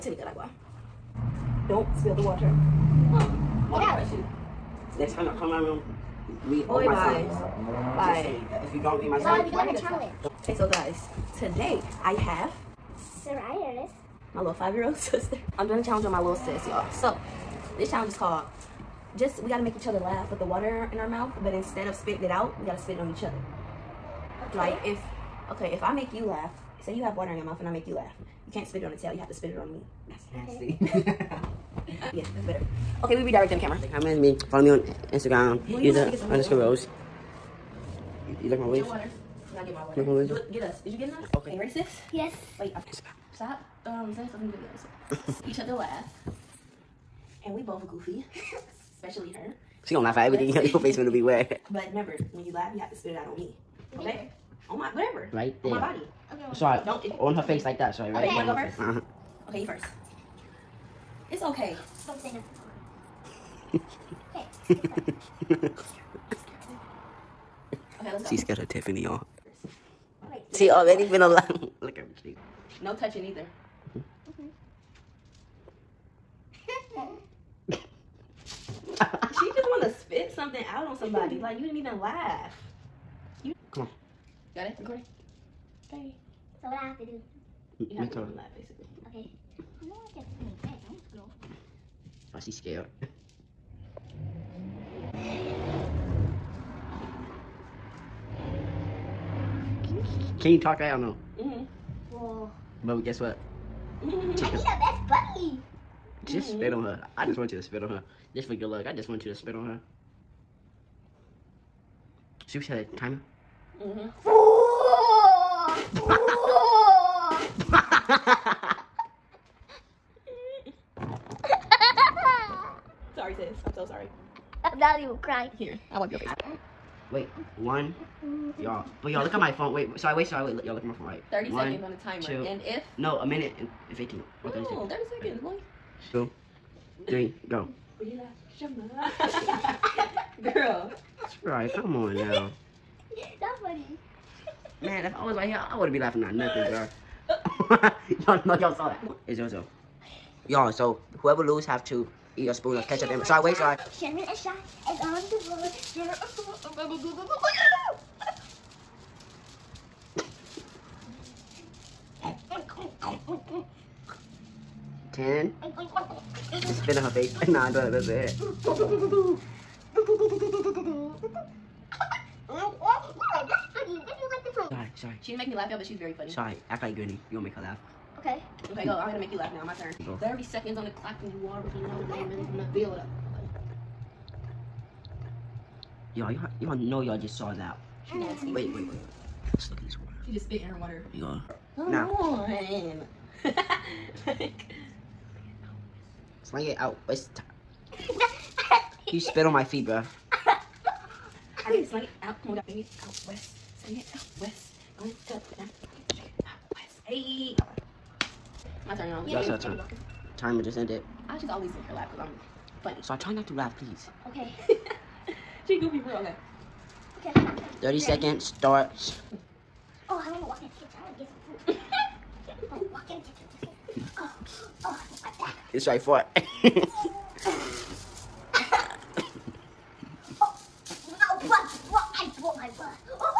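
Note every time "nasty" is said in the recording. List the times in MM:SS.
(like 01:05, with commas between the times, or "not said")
00:30, 03:08.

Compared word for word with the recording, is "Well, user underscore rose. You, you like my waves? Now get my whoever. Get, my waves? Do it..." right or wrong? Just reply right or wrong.
wrong.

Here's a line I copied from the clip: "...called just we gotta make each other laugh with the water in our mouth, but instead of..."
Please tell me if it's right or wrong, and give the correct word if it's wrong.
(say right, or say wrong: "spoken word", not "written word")
right.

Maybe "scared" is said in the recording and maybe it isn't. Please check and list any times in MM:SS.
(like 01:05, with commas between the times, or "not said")
01:08, 01:32.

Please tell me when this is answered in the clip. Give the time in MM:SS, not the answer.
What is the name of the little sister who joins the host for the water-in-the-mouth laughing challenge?
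00:13.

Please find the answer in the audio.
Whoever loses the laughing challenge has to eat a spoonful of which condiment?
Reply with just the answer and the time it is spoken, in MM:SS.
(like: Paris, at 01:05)
ketchup, at 02:32.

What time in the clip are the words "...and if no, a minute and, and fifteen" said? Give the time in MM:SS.
02:12.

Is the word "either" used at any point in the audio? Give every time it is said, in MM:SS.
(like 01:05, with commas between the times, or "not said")
01:13.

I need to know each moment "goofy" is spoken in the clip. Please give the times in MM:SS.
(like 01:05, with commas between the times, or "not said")
00:47, 03:35.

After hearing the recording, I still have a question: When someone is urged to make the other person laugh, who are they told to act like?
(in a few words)
Granny.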